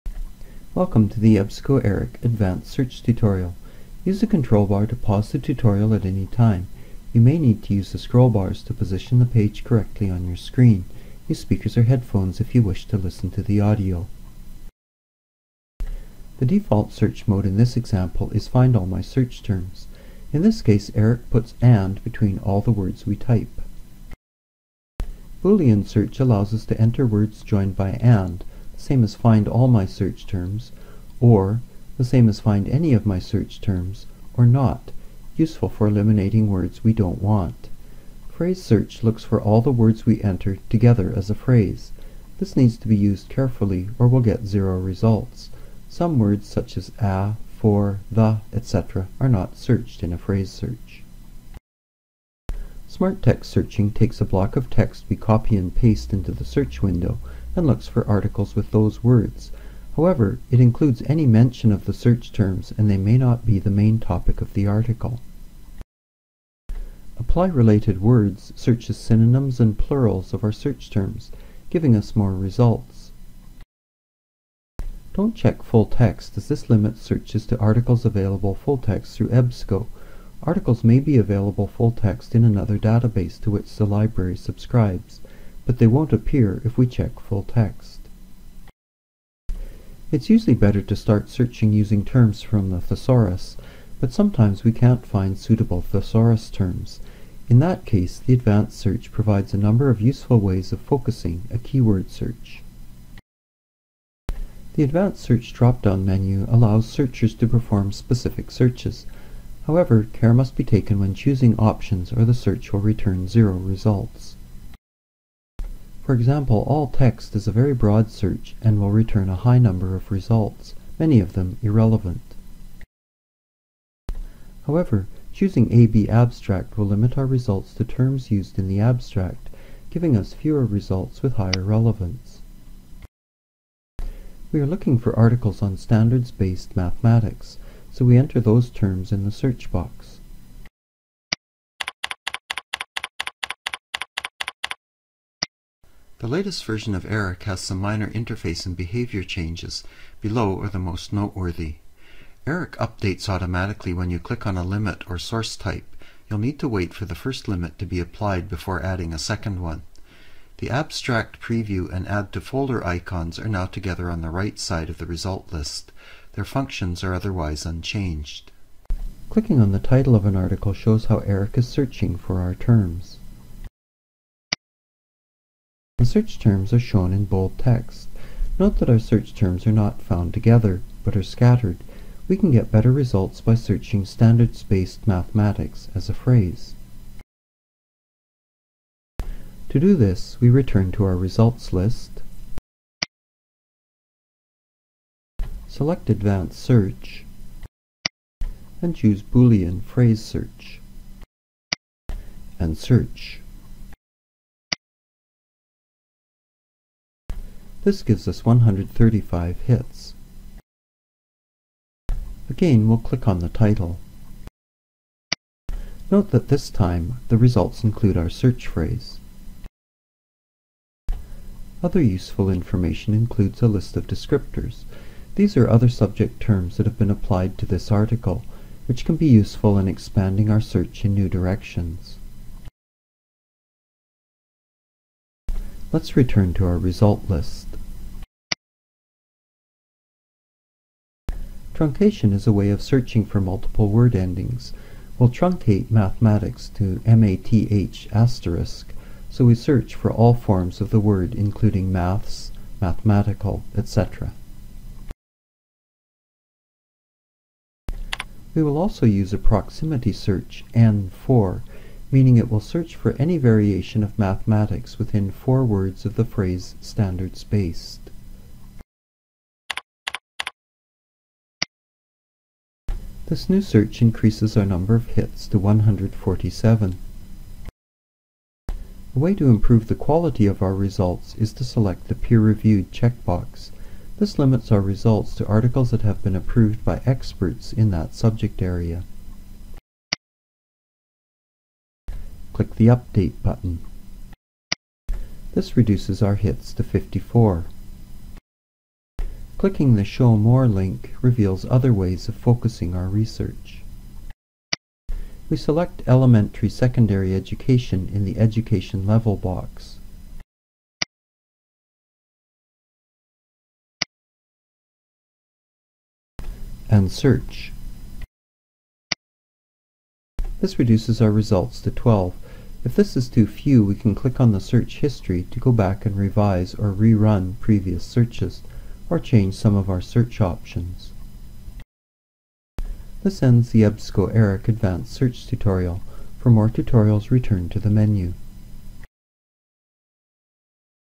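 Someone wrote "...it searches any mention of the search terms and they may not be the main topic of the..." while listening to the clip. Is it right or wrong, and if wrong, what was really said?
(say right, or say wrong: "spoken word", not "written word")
wrong: "includes", not "searches".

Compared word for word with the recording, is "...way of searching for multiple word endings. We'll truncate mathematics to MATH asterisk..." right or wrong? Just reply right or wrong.
right.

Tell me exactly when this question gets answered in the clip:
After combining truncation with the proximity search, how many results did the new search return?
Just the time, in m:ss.
4:35.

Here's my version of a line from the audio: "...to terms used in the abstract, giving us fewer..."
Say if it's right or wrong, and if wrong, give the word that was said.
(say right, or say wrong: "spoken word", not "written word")
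right.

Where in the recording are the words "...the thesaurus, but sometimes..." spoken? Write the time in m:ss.
1:32.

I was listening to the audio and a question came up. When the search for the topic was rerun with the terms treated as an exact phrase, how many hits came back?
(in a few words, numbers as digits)
135.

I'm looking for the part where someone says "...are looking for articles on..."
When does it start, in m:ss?
2:14.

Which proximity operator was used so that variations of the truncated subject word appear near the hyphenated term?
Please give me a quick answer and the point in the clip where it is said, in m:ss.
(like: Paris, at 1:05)
N4, at 4:20.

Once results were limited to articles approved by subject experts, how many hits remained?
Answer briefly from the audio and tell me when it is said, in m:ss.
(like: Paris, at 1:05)
54, at 4:56.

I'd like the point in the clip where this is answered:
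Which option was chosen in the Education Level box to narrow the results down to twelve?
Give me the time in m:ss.
5:06.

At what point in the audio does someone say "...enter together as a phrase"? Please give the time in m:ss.
0:40.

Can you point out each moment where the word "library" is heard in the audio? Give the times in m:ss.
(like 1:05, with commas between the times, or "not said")
1:23.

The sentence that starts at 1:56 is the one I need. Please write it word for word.
For example, all text is a very broad search and will return a high number of results, many of them irrelevant.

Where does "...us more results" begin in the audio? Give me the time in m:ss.
1:11.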